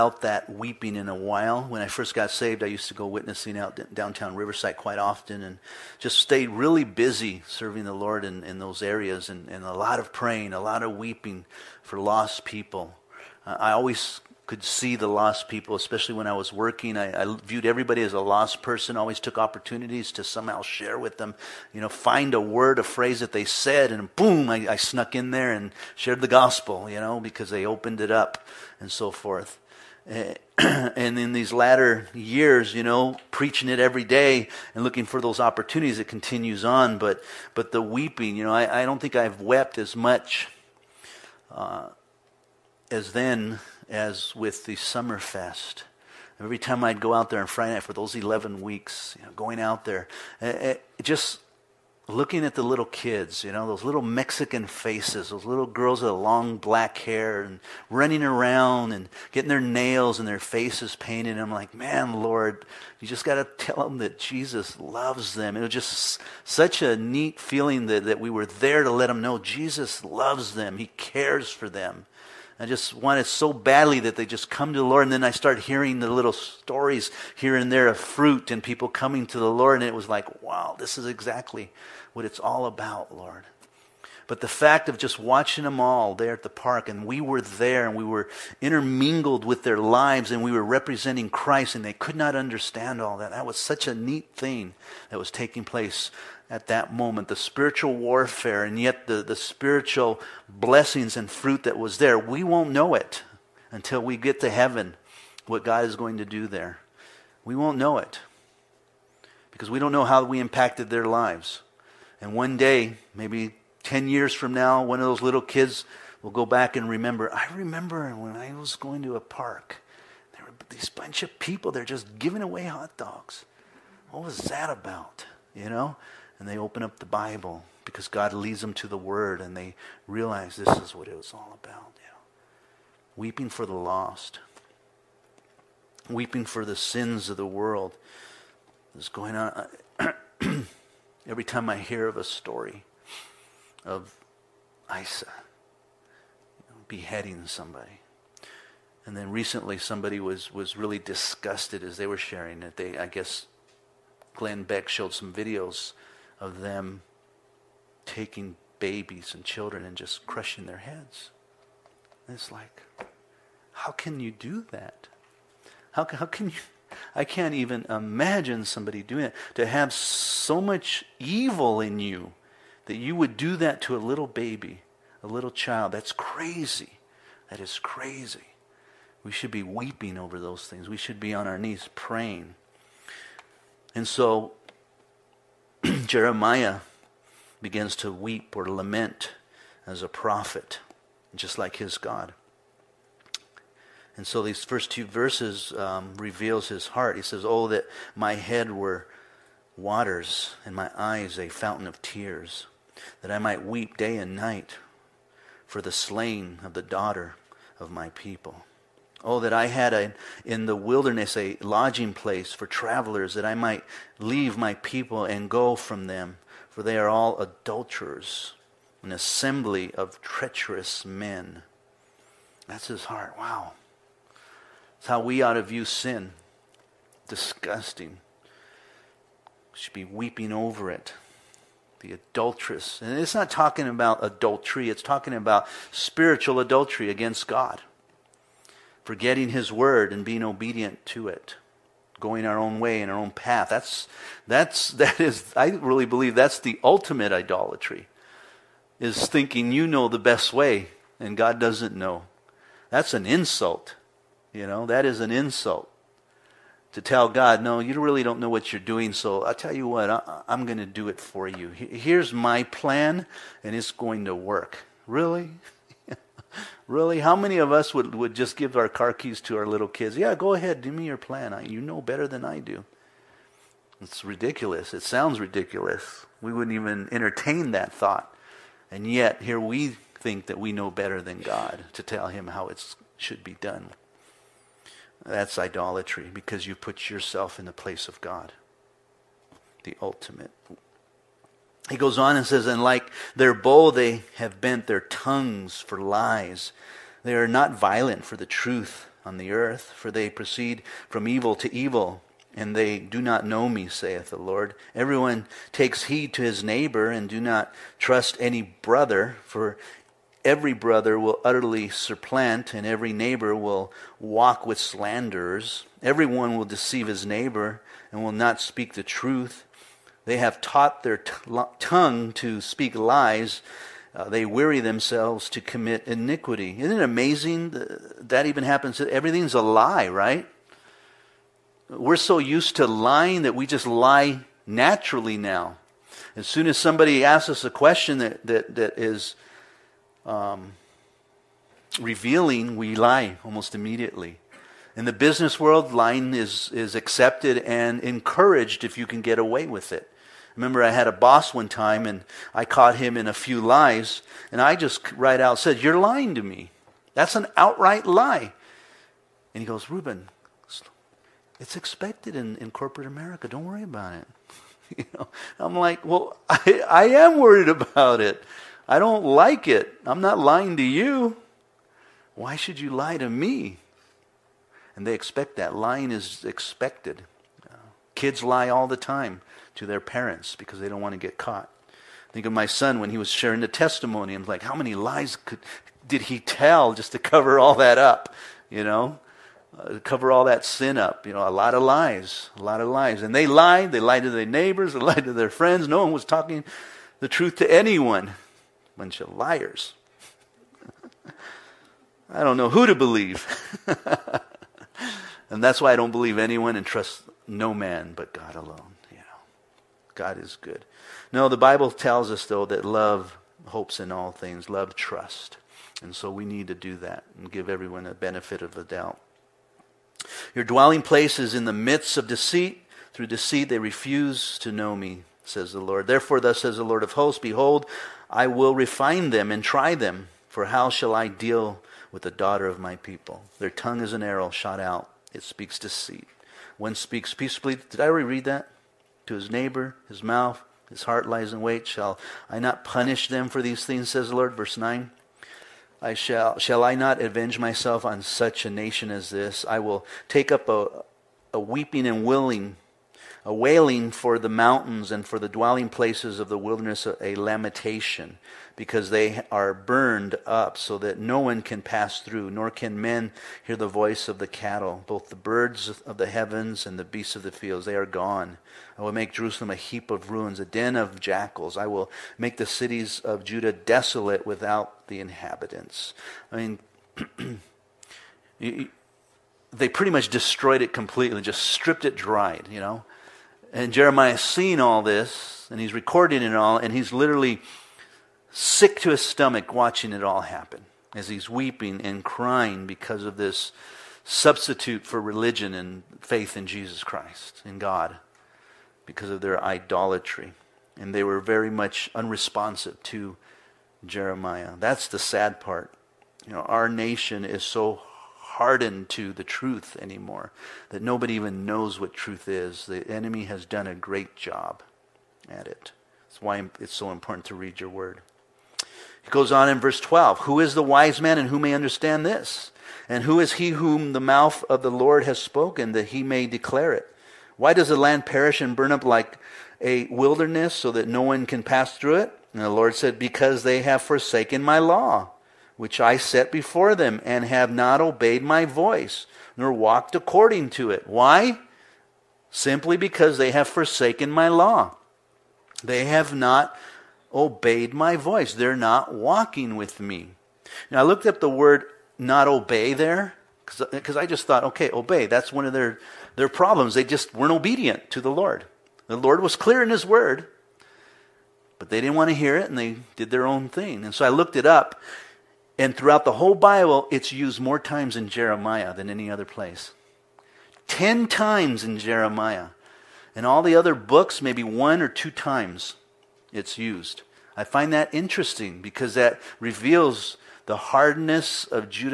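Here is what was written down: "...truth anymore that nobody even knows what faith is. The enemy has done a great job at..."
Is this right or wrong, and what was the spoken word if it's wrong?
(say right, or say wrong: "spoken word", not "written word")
wrong: "truth", not "faith".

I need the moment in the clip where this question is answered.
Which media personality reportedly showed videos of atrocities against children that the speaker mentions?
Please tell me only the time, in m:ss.
2:34.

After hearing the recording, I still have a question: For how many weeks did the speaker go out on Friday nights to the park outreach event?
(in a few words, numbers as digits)
11.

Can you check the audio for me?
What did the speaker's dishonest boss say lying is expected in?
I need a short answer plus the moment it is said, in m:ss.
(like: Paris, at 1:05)
Corporate America, at 6:02.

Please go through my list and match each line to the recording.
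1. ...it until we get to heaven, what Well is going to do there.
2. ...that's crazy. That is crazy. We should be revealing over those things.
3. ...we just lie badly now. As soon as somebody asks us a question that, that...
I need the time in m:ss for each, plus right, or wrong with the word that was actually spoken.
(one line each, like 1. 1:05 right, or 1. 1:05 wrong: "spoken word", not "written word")
1. 1:42 wrong: "God", not "Well"
2. 2:55 wrong: "weeping", not "revealing"
3. 5:33 wrong: "naturally", not "badly".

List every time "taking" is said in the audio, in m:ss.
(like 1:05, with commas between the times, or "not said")
1:35, 2:38.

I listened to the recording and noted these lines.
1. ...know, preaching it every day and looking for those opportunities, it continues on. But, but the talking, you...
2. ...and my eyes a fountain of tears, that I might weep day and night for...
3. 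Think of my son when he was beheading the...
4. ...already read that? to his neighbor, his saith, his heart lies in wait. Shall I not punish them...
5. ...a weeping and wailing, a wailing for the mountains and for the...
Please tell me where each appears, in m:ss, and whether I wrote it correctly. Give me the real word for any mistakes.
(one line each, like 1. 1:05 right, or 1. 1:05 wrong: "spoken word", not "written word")
1. 0:32 wrong: "weeping", not "talking"
2. 3:20 right
3. 6:22 wrong: "sharing", not "beheading"
4. 7:18 wrong: "mouth", not "saith"
5. 7:31 right.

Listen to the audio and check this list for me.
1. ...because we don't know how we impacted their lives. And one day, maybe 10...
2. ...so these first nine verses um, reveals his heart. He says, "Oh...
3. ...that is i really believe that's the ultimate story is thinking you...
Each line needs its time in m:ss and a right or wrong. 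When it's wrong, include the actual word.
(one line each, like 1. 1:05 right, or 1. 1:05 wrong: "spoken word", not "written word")
1. 1:49 right
2. 3:14 wrong: "two", not "nine"
3. 4:04 wrong: "idolatry", not "story".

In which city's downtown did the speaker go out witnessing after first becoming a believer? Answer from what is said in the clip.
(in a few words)
Riverside.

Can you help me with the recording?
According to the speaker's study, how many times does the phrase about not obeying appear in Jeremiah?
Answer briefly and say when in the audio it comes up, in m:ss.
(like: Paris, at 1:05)
10, at 9:30.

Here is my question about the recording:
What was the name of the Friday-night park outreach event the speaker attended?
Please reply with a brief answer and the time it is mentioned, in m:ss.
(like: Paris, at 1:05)
Summerfest, at 0:44.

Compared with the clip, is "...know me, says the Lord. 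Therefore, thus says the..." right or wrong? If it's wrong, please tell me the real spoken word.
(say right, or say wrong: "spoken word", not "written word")
right.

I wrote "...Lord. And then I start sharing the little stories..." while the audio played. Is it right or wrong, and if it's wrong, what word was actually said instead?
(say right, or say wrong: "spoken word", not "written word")
wrong: "hearing", not "sharing".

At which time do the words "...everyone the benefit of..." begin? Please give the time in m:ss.
6:57.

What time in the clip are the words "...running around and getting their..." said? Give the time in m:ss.
0:57.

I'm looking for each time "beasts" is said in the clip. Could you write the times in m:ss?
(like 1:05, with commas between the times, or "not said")
7:47.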